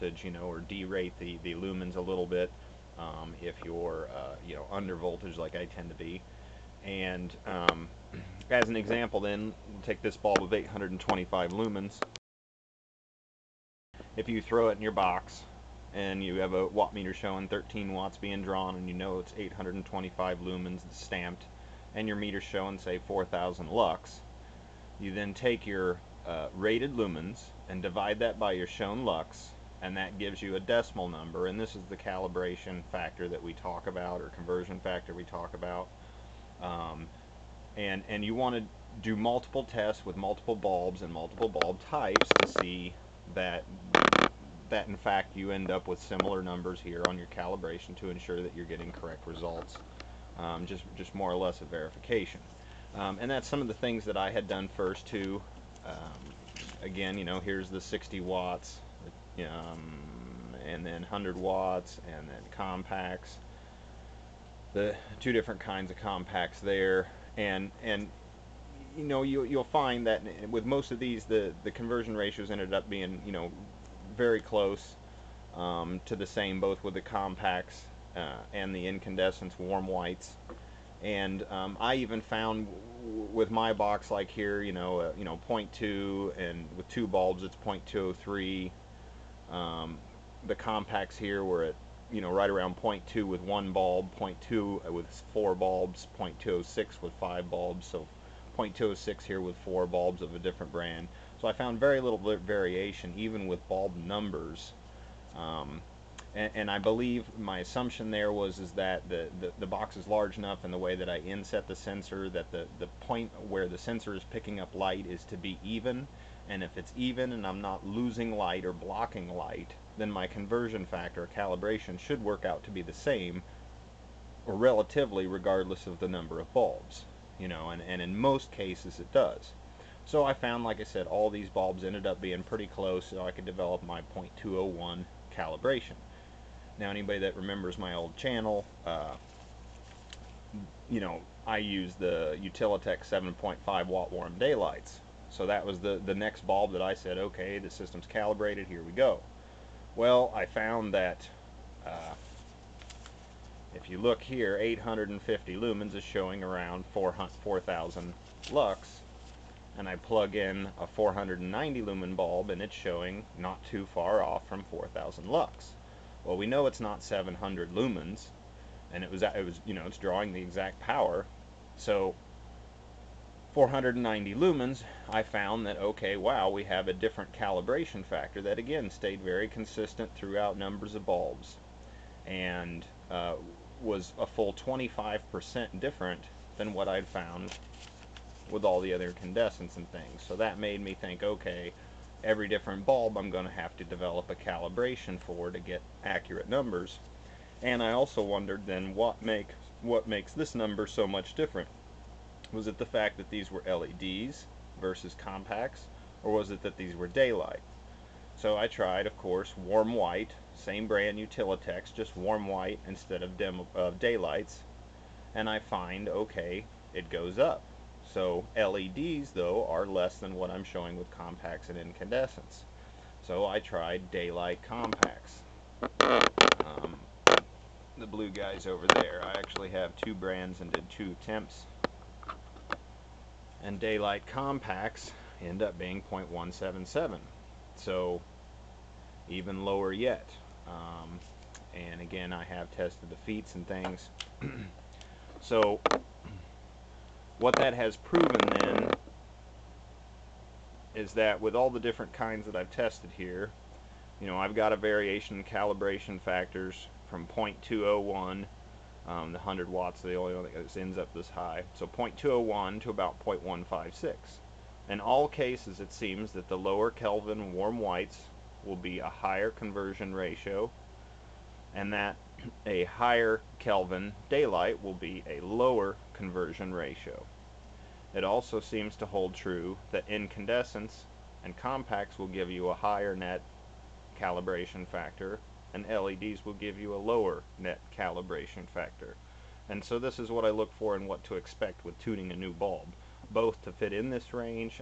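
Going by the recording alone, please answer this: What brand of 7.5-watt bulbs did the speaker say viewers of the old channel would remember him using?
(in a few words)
Utilitech.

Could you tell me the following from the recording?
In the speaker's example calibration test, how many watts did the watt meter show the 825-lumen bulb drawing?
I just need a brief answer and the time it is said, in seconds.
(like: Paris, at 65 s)
13 watts, at 17 s.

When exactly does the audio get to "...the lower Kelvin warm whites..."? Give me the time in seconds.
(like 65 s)
266 s.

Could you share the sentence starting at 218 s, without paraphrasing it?
So LEDs, though, are less than what I'm showing with compacts and incandescents.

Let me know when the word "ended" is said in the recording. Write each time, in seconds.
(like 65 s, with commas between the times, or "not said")
72 s, 131 s.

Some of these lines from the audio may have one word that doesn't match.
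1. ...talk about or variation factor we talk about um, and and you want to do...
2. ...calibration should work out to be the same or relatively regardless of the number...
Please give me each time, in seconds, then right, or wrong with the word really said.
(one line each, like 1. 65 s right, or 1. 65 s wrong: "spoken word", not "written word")
1. 33 s wrong: "conversion", not "variation"
2. 121 s right.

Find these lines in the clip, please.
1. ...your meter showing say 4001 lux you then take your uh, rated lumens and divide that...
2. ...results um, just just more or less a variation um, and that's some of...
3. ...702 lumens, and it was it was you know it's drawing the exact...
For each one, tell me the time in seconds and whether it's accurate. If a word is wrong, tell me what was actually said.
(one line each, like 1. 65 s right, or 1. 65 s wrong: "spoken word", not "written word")
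1. 22 s wrong: "4000", not "4001"
2. 49 s wrong: "verification", not "variation"
3. 167 s wrong: "700", not "702".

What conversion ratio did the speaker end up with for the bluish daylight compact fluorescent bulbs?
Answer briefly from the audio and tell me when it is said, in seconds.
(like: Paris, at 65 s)
0.177, at 236 s.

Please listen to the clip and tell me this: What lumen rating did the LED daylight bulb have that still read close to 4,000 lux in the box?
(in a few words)
490 lumens.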